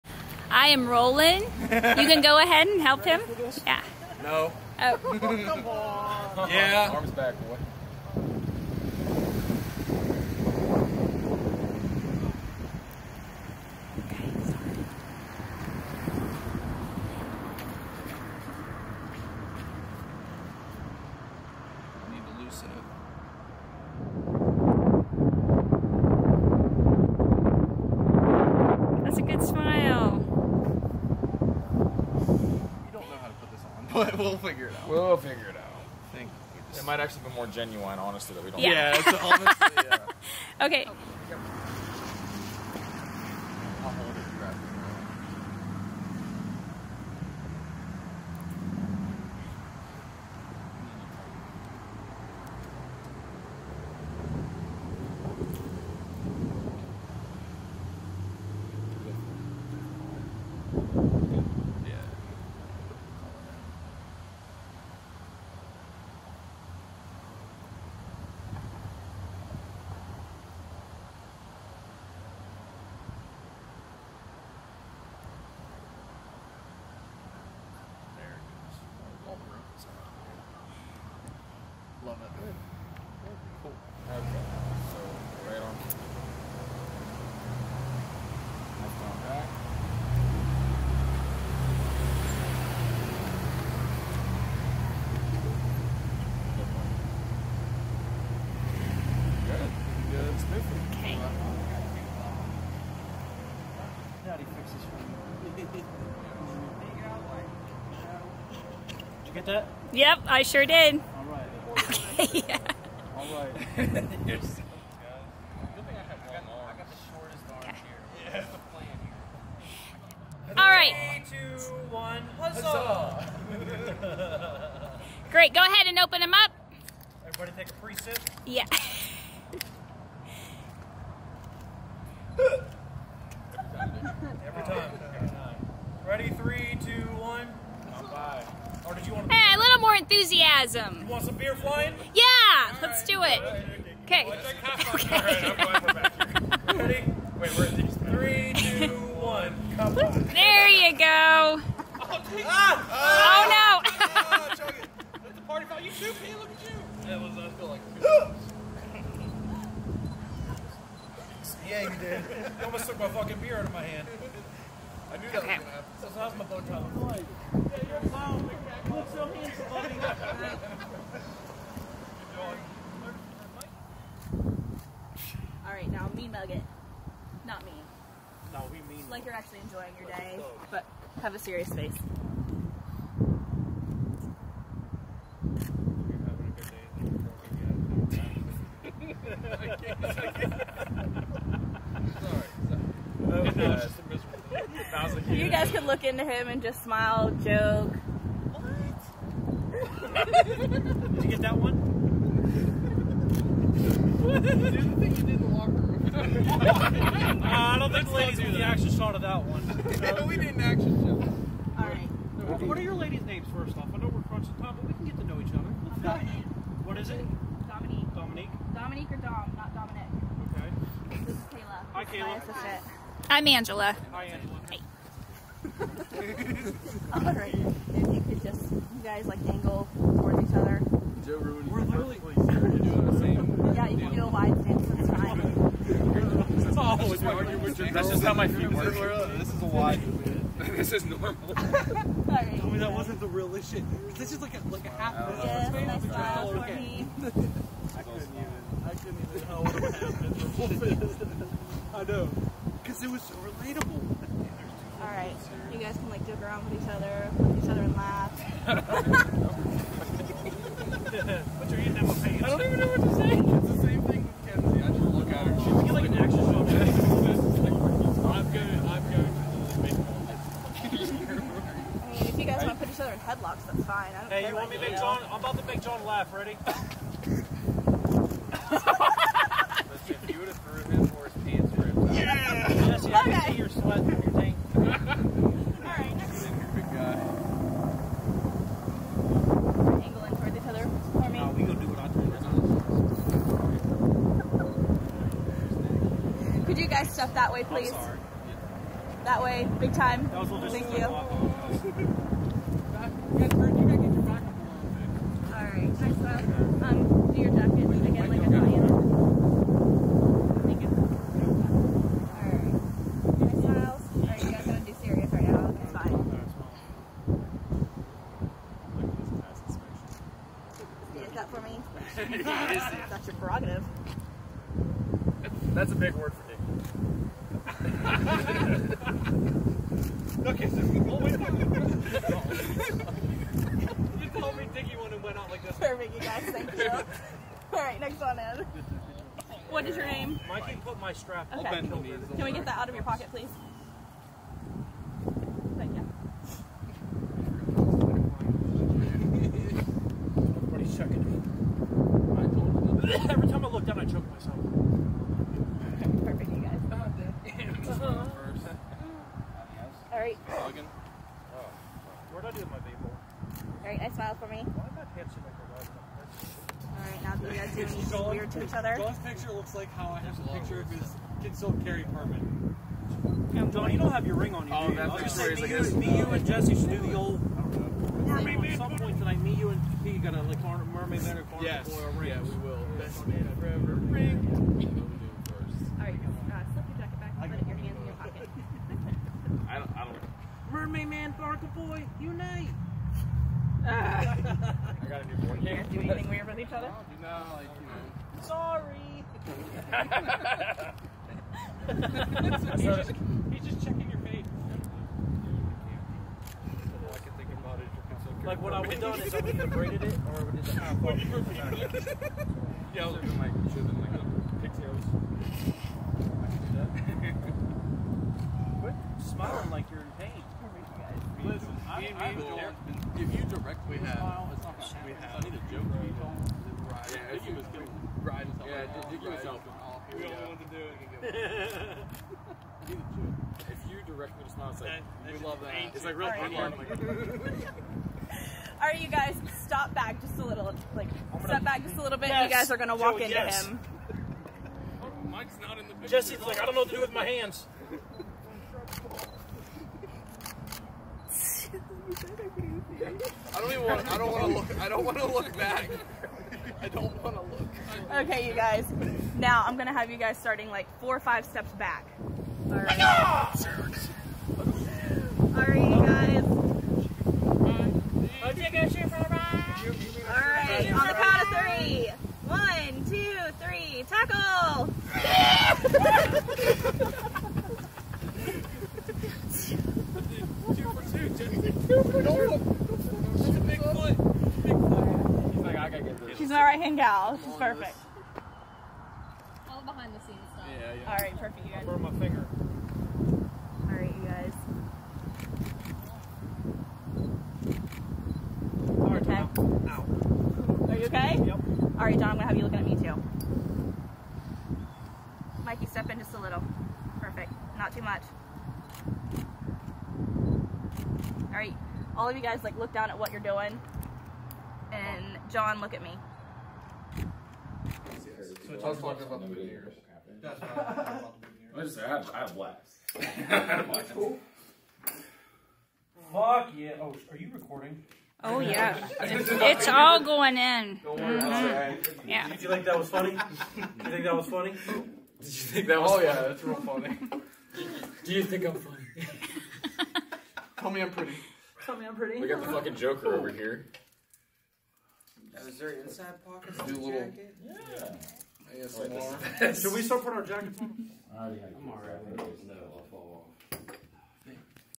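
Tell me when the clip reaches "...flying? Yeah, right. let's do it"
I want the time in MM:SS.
02:21.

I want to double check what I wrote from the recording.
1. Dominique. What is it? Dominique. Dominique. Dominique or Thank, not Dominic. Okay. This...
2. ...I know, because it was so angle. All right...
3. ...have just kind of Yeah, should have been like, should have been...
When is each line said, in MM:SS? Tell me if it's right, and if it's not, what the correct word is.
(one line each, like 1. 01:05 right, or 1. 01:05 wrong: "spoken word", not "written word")
1. 03:36 wrong: "Dom", not "Thank"
2. 04:11 wrong: "relatable", not "angle"
3. 06:50 right.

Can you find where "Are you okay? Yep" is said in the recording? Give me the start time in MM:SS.
08:20.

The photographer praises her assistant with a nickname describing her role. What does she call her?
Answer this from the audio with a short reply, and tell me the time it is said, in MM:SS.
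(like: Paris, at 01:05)
Right hand gal, at 08:06.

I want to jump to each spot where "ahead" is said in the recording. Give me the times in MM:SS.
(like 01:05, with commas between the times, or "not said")
00:02, 02:05.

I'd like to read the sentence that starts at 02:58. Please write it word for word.
No, we mean Like you're actually enjoying your day, but have a serious face.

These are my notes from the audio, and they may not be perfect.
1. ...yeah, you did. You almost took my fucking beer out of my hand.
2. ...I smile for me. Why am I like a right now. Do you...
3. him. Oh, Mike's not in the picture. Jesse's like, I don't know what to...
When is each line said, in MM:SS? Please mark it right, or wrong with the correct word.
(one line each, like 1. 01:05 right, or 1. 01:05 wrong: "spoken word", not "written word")
1. 02:41 right
2. 06:04 right
3. 07:23 right.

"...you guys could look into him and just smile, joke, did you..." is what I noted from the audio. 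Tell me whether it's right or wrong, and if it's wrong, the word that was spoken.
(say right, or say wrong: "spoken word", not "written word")
right.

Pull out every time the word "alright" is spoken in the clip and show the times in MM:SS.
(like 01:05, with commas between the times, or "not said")
02:48, 04:44, 09:11.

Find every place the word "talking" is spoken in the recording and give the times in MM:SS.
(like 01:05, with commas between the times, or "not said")
08:41.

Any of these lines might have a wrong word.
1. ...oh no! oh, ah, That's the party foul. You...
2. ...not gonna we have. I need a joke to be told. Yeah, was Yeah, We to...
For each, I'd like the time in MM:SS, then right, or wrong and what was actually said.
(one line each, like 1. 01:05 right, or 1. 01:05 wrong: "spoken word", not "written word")
1. 02:33 right
2. 07:04 right.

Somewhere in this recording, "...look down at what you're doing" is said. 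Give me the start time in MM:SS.
08:32.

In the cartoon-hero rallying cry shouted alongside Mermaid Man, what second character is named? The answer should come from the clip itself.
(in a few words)
Barker boy.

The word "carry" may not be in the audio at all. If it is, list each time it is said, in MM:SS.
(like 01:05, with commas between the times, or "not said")
06:11.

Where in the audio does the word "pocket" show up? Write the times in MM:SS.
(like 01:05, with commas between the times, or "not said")
05:43, 06:28, 09:06.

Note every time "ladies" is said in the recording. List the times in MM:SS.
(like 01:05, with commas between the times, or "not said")
03:28, 03:32.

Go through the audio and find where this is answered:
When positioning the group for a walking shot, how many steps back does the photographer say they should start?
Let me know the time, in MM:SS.
07:40.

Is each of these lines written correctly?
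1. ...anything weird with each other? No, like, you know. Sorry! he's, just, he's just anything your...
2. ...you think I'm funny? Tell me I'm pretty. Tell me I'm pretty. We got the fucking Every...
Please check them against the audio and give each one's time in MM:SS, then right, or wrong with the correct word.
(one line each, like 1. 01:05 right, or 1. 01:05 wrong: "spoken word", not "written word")
1. 06:36 wrong: "checking", not "anything"
2. 08:58 wrong: "Joker", not "Every".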